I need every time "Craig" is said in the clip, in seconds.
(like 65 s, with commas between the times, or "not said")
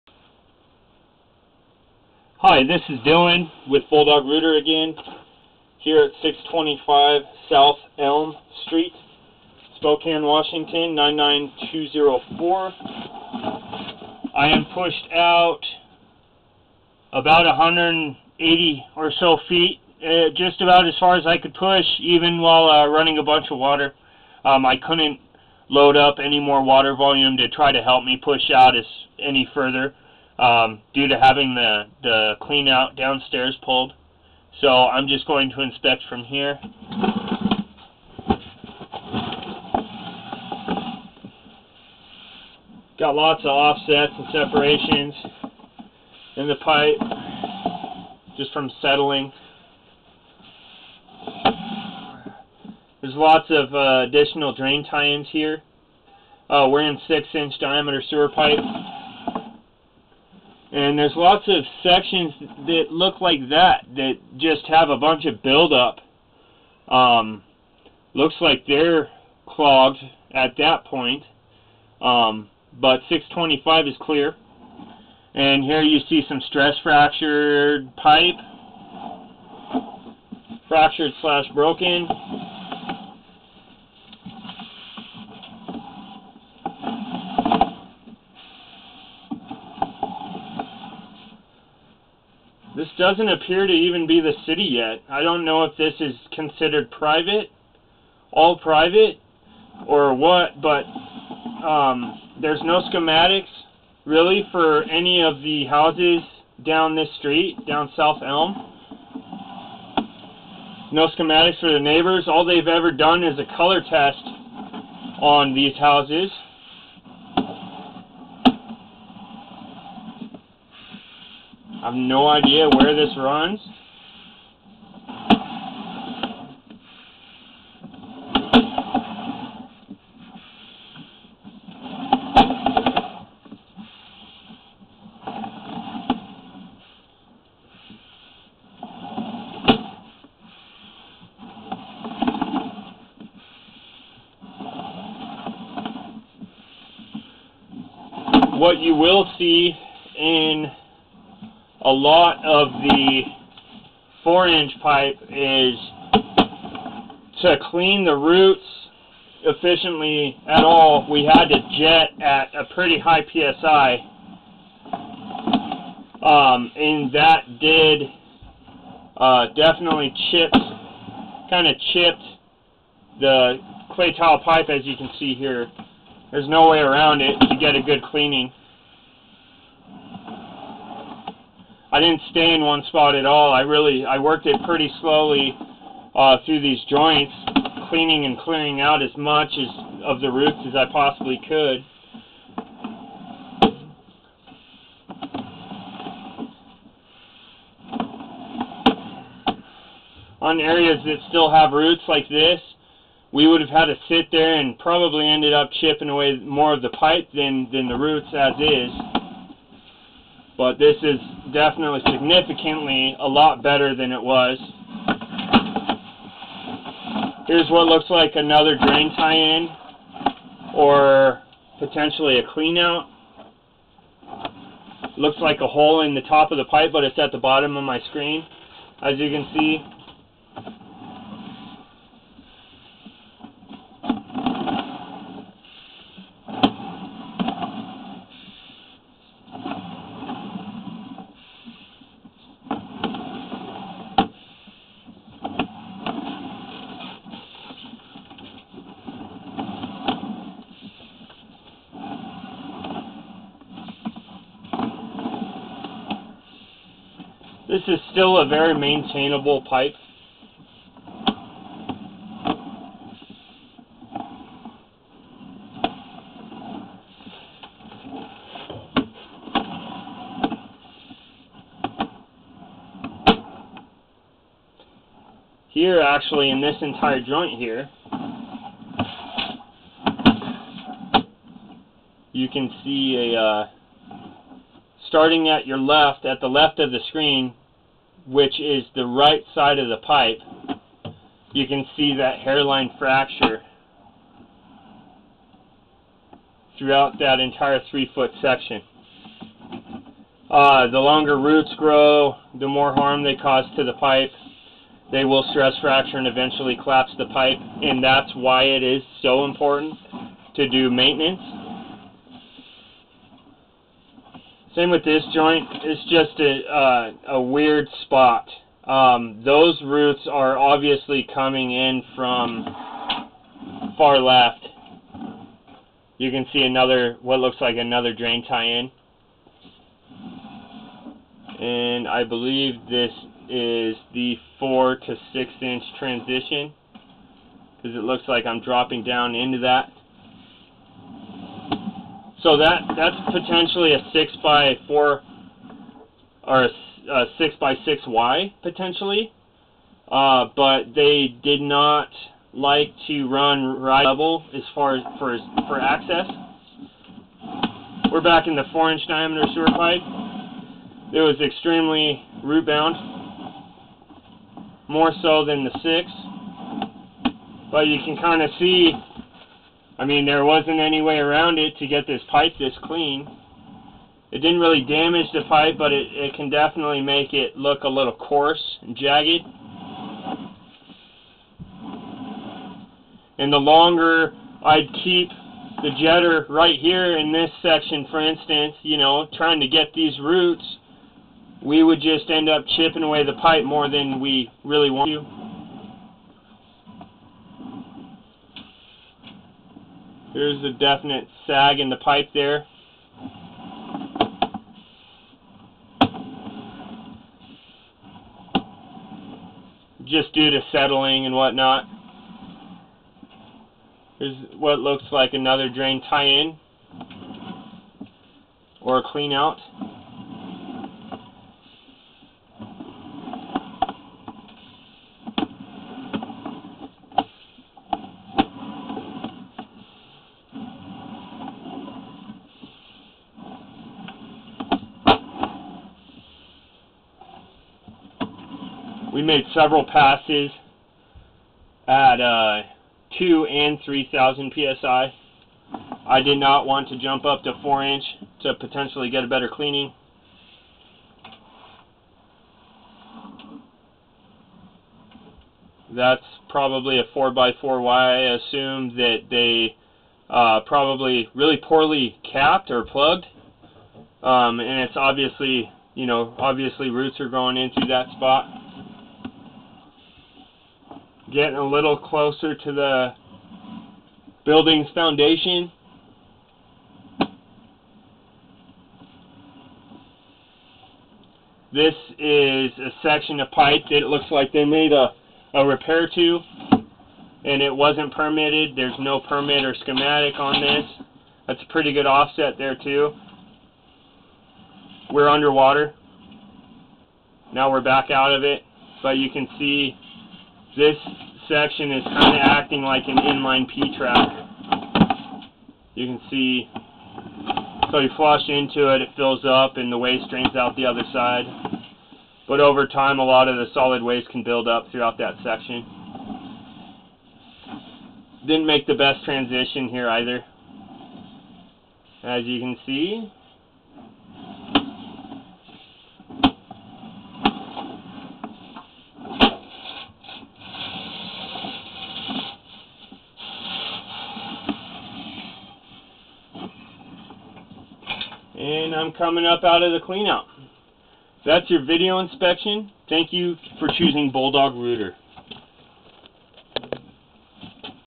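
not said.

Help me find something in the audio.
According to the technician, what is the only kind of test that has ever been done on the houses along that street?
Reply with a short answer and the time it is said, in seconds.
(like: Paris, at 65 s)
color test, at 113 s.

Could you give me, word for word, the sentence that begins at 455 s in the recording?
That's probably a 4x4 Y I assume that they uh, probably really poorly capped or plugged.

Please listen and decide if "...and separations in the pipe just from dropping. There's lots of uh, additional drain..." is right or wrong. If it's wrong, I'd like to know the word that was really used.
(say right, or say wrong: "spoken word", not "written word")
wrong: "settling", not "dropping".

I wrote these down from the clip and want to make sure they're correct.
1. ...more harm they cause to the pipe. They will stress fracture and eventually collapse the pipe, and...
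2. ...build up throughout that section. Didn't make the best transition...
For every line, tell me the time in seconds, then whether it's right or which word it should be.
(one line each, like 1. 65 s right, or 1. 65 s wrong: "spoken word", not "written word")
1. 302 s right
2. 514 s right.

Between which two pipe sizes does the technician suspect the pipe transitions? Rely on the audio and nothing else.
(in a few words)
4 to 6 inch.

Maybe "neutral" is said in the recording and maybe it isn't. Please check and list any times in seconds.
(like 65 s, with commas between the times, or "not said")
not said.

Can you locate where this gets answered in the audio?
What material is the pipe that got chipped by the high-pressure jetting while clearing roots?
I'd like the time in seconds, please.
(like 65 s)
173 s.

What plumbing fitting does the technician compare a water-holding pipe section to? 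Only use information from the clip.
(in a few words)
inline P-trap.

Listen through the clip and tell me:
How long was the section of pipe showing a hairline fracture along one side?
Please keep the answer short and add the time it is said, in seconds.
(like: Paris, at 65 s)
three foot, at 297 s.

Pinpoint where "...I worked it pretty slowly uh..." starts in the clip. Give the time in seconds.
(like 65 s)
184 s.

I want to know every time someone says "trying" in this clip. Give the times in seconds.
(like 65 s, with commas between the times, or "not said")
389 s.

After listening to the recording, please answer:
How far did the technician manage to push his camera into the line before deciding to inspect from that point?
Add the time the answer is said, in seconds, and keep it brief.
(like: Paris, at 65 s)
180 feet, at 17 s.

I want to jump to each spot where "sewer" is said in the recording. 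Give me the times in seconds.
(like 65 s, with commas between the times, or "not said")
58 s, 359 s.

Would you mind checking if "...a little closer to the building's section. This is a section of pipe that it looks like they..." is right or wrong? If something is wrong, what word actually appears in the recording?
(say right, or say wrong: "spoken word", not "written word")
wrong: "foundation", not "section".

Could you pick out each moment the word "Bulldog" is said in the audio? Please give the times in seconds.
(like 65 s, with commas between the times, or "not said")
3 s, 544 s.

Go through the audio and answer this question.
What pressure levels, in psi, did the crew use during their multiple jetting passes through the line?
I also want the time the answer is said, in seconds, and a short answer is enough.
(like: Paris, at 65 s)
2,000 and 3,000, at 443 s.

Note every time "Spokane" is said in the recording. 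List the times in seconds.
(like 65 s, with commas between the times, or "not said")
9 s.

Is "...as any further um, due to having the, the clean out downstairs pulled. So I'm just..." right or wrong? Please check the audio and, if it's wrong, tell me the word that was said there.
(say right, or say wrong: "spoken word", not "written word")
right.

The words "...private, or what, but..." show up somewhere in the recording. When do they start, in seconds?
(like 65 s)
98 s.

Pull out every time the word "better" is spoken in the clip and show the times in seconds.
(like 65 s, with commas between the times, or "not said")
213 s, 449 s.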